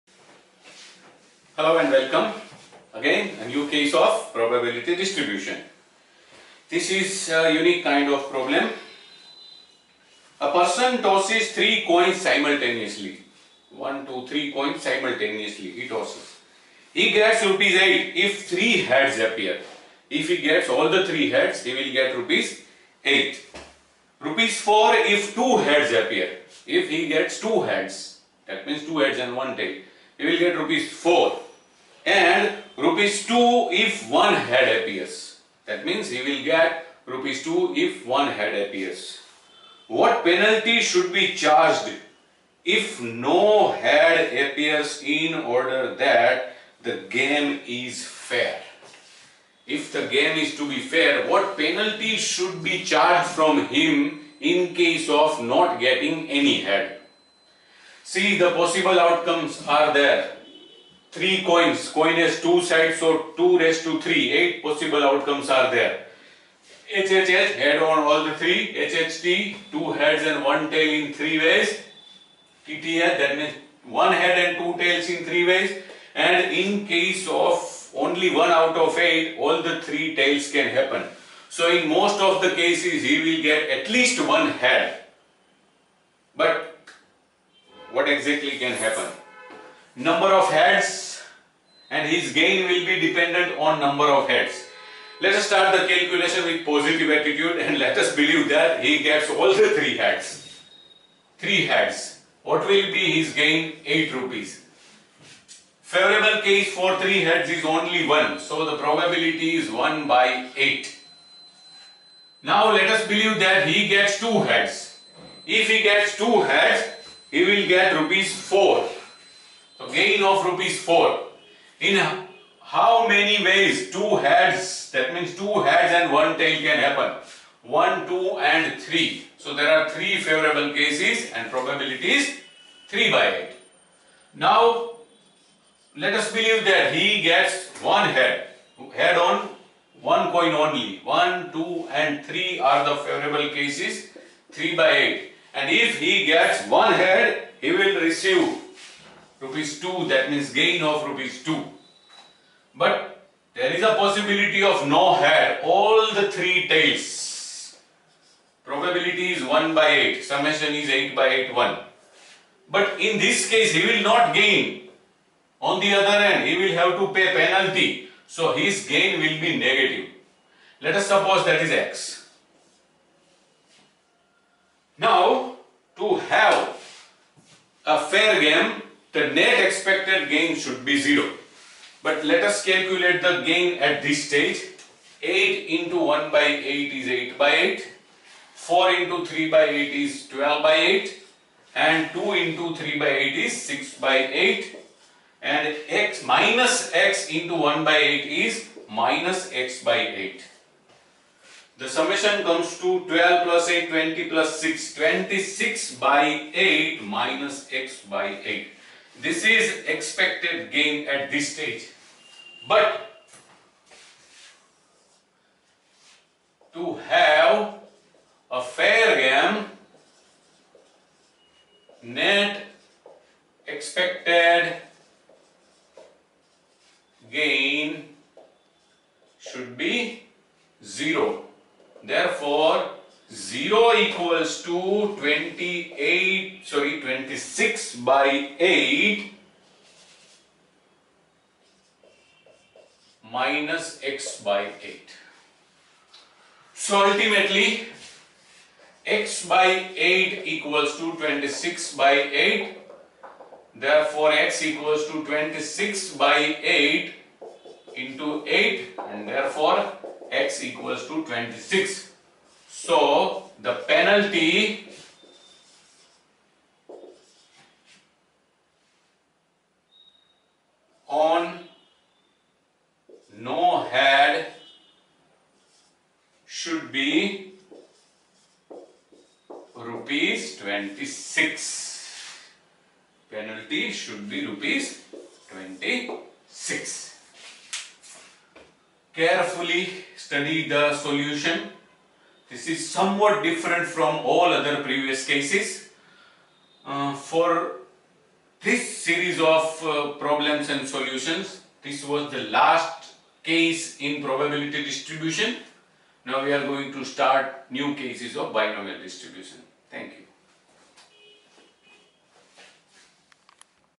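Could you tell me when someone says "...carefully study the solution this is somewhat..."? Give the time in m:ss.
4:49.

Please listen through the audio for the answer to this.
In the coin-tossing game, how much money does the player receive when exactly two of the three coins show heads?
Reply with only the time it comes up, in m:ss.
0:24.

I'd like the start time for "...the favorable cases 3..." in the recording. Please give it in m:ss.
2:22.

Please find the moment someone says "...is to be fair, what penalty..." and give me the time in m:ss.
0:50.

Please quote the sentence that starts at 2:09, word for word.
So there are 3 favorable cases and probabilities 3 by 8.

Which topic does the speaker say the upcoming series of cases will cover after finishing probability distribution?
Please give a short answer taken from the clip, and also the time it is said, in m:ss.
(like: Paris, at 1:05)
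Binomial distribution, at 5:08.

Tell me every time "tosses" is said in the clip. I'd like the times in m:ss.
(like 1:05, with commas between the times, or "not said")
0:11, 0:15.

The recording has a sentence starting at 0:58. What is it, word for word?
See, the possible outcomes are there three coins.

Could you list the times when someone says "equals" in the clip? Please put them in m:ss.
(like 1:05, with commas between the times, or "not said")
3:53, 4:10, 4:14, 4:20.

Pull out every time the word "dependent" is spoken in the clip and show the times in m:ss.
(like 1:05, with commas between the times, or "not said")
1:33.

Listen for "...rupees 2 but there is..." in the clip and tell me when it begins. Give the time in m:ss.
2:31.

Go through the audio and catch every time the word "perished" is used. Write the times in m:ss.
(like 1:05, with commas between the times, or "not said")
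not said.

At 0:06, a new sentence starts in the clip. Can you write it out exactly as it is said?
This is a unique kind of problem.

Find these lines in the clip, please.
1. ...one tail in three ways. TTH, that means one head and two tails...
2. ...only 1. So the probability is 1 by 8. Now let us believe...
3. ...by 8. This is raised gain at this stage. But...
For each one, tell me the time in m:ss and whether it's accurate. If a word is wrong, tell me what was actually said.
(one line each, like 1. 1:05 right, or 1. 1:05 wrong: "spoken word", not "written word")
1. 1:10 right
2. 1:47 right
3. 3:28 wrong: "expected", not "raised".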